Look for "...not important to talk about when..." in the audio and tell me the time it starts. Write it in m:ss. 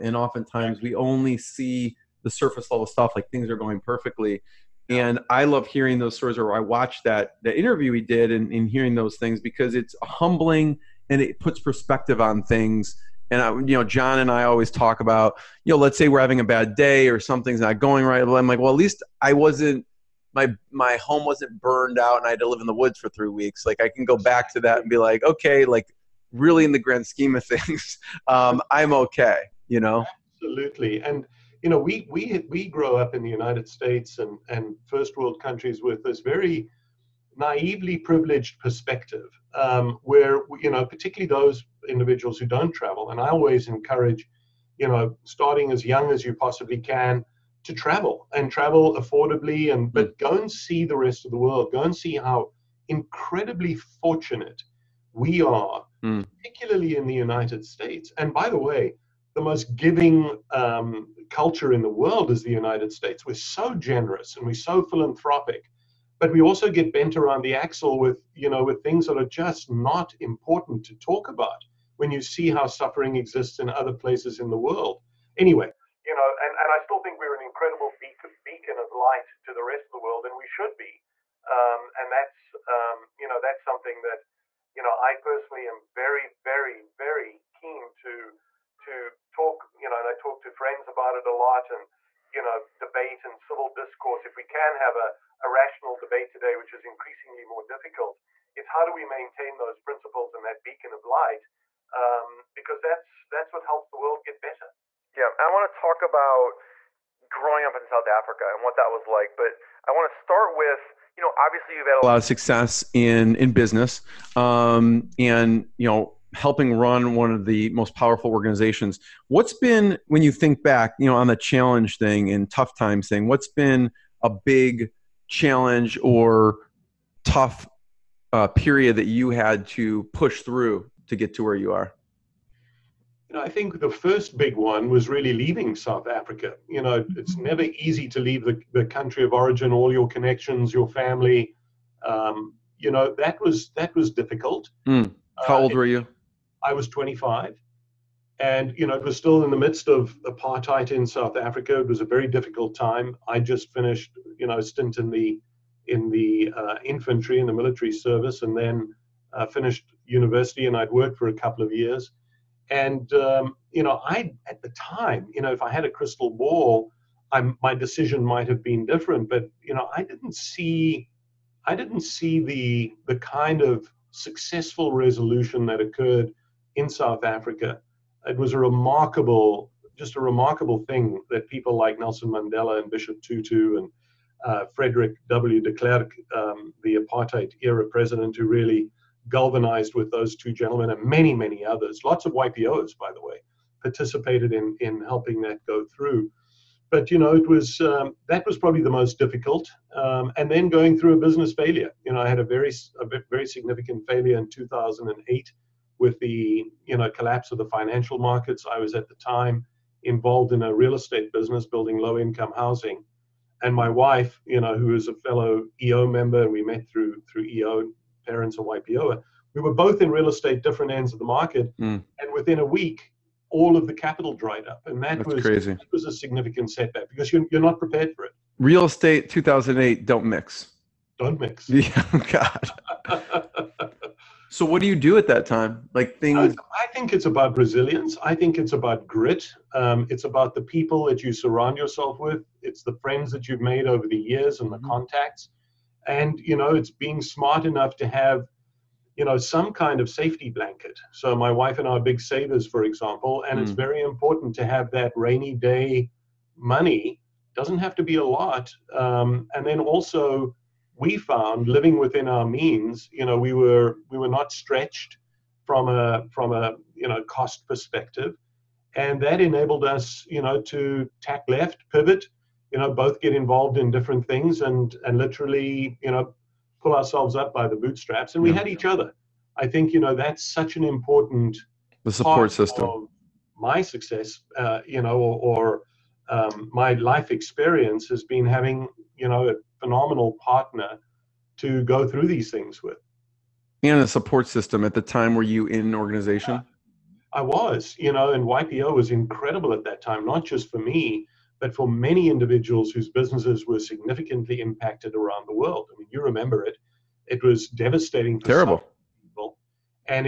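1:09.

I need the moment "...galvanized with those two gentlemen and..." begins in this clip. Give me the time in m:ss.
3:09.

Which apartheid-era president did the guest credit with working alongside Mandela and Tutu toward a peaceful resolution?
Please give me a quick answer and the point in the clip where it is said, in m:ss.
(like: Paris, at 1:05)
Frederick W. de Klerk, at 3:04.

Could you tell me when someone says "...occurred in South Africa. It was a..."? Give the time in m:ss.
2:55.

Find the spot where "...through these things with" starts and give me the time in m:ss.
4:52.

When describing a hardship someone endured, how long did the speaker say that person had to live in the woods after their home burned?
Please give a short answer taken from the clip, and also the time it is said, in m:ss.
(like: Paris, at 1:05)
3 weeks, at 0:23.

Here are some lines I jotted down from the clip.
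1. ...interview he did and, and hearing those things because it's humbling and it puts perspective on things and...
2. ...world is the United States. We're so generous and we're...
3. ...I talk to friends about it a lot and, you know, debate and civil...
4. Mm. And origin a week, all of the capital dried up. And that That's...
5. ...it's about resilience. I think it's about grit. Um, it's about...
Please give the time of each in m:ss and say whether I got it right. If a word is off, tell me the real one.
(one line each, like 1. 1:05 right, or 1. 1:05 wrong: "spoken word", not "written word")
1. 0:07 right
2. 1:01 right
3. 1:30 right
4. 3:41 wrong: "within", not "origin"
5. 3:57 right.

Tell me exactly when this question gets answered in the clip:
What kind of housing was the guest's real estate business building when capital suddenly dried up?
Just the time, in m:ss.
3:31.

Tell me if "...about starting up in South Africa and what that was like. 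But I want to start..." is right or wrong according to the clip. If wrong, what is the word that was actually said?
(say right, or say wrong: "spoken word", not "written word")
wrong: "growing", not "starting".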